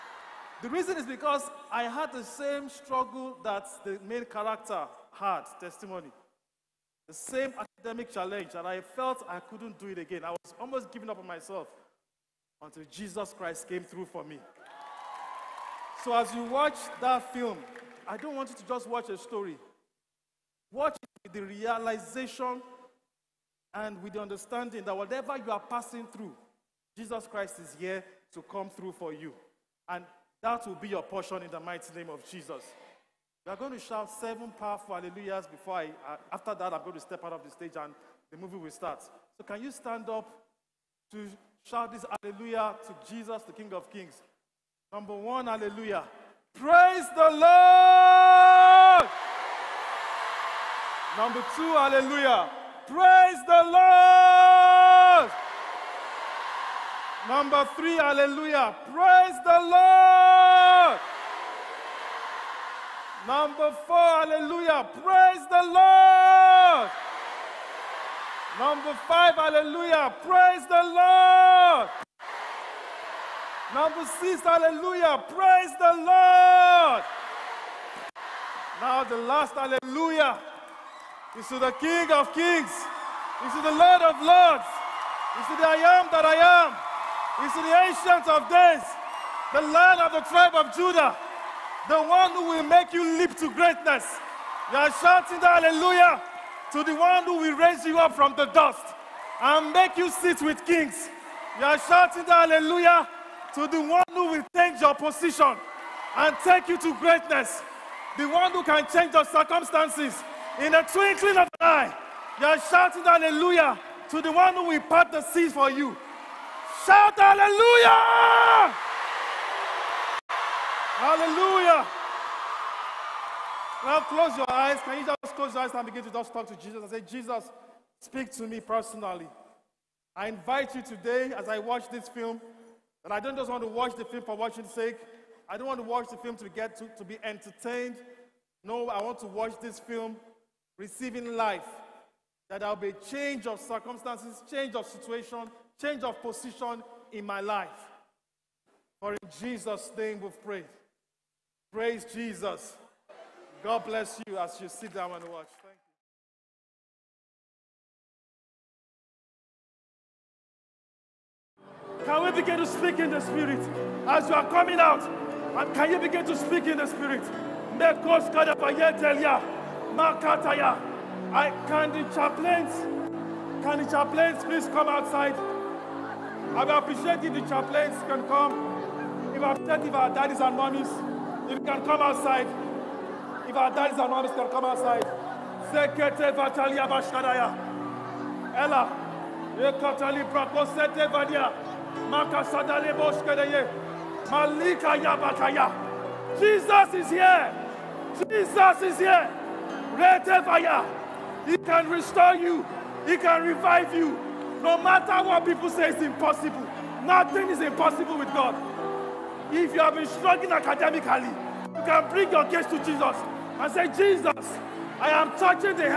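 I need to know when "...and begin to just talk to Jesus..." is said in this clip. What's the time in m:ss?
2:05.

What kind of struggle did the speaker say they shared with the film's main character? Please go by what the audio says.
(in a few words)
academic challenge.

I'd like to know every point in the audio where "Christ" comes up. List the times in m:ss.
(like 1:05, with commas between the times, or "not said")
0:13, 0:27.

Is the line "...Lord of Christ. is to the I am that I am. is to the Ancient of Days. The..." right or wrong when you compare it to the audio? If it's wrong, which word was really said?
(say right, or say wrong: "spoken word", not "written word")
wrong: "Lords", not "Christ".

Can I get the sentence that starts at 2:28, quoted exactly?
For in Jesus' name we've prayed.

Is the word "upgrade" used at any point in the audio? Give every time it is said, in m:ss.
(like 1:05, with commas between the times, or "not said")
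not said.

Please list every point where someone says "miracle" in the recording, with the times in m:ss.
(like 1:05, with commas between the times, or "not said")
not said.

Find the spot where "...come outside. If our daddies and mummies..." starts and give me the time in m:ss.
3:01.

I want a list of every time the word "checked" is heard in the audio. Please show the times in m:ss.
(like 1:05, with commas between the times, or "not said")
not said.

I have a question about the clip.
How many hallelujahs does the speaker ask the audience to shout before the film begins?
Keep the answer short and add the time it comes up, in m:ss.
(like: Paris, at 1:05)
7, at 0:34.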